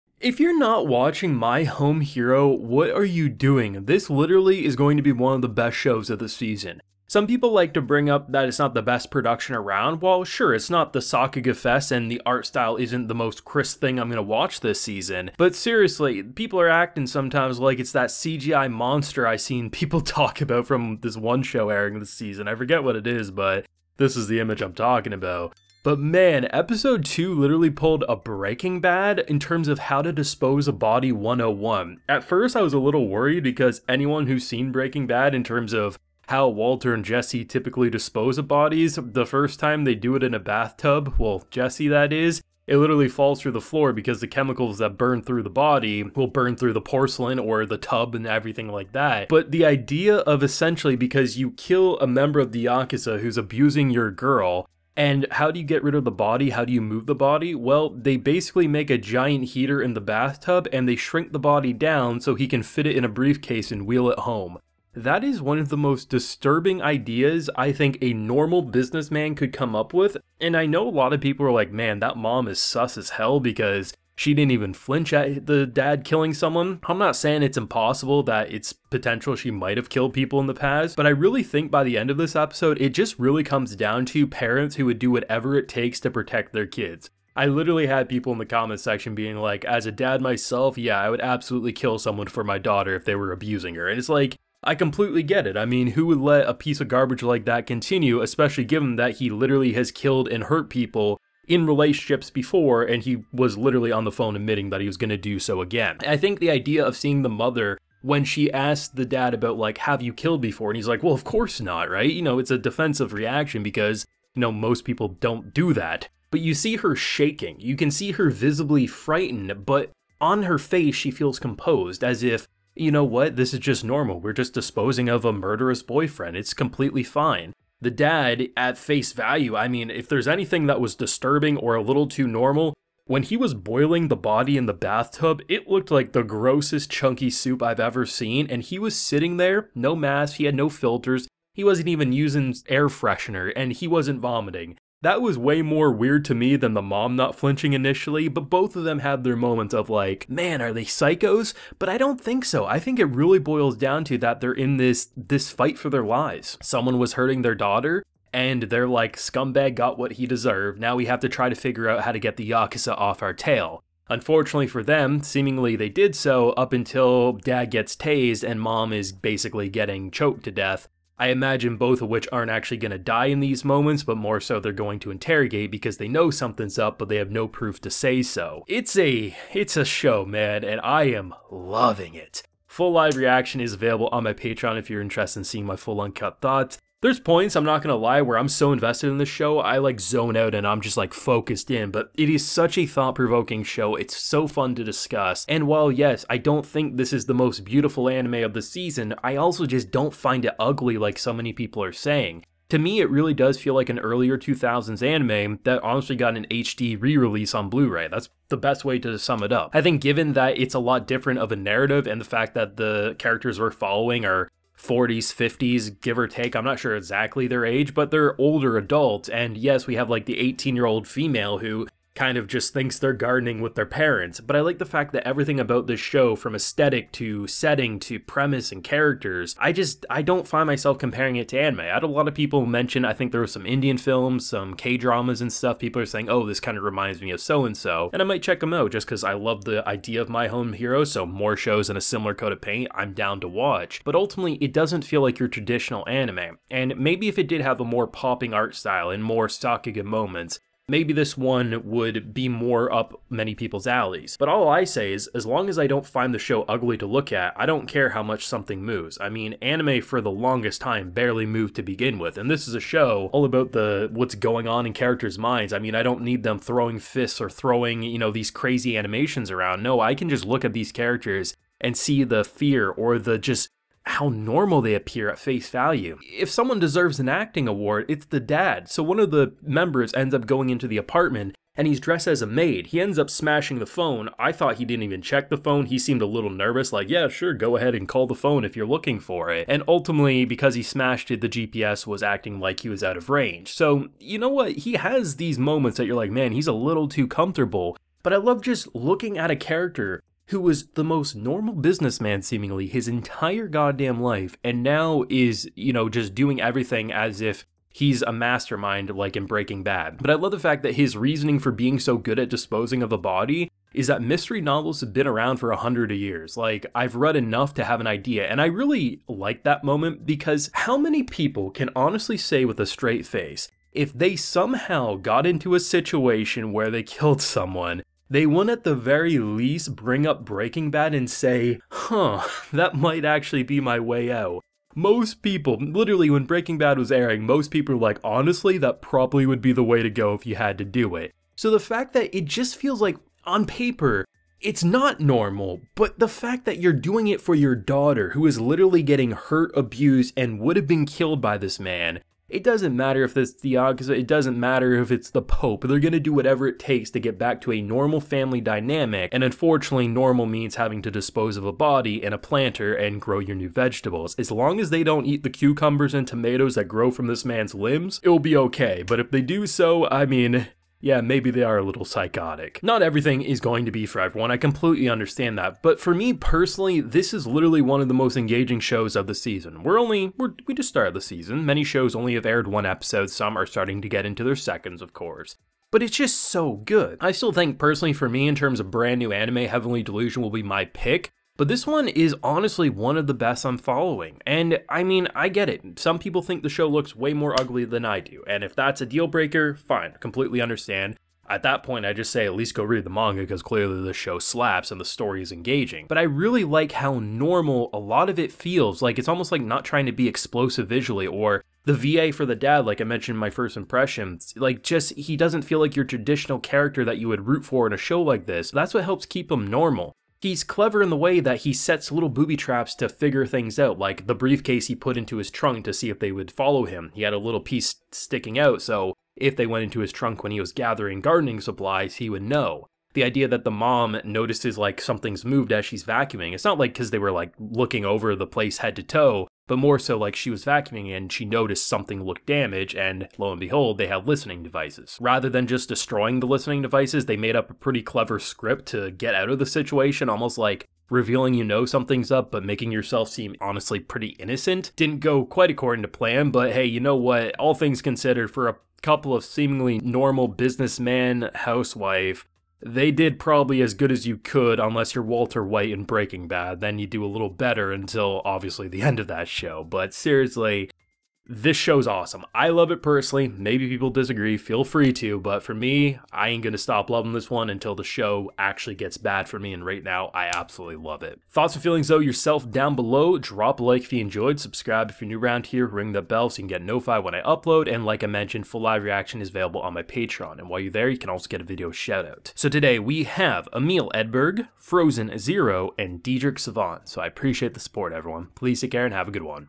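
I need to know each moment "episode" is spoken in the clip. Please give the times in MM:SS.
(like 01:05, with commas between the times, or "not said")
00:26, 01:22, 06:22.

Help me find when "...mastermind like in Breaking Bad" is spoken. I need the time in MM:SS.
05:08.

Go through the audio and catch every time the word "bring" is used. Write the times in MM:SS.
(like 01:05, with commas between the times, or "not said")
00:07, 05:29.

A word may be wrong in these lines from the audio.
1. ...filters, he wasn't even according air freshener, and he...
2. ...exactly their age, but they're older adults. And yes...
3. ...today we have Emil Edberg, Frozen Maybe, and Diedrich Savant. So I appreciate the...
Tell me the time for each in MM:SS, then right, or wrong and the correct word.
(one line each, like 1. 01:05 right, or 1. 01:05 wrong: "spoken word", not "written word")
1. 02:20 wrong: "using", not "according"
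2. 03:36 right
3. 08:12 wrong: "Zero", not "Maybe".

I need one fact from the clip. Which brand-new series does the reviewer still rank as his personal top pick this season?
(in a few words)
Heavenly Delusion.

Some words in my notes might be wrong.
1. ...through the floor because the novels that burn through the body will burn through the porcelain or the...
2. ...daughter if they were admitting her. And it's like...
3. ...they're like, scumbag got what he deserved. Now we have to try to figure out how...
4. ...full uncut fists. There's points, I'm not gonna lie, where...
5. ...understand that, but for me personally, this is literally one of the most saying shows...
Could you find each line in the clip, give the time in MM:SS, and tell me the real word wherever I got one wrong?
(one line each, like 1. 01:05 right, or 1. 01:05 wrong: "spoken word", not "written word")
1. 00:43 wrong: "chemicals", not "novels"
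2. 01:32 wrong: "abusing", not "admitting"
3. 02:38 right
4. 03:05 wrong: "thoughts", not "fists"
5. 06:15 wrong: "engaging", not "saying".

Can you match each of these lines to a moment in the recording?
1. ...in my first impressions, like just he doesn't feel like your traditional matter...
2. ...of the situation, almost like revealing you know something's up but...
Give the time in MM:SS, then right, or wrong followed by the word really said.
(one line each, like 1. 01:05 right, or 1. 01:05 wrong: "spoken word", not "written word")
1. 06:53 wrong: "character", not "matter"
2. 07:29 right.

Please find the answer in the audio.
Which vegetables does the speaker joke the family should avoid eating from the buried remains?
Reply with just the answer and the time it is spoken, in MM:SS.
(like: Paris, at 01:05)
Cucumbers and tomatoes, at 06:05.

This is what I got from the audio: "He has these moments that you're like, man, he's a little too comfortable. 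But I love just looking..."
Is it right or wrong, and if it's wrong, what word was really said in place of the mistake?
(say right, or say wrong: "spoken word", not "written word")
right.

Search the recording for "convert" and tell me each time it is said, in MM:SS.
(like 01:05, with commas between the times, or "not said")
not said.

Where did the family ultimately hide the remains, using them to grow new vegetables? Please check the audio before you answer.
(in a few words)
A planter.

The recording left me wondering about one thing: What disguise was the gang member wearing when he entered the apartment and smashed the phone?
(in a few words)
A maid.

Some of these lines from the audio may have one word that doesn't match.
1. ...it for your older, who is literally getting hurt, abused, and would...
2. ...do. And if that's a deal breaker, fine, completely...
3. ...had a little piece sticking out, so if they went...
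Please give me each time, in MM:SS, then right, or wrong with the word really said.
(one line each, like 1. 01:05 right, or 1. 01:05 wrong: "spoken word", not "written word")
1. 05:47 wrong: "daughter", not "older"
2. 06:38 right
3. 07:07 right.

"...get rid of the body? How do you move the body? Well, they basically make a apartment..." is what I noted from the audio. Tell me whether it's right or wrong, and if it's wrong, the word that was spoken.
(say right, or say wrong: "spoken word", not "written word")
wrong: "giant", not "apartment".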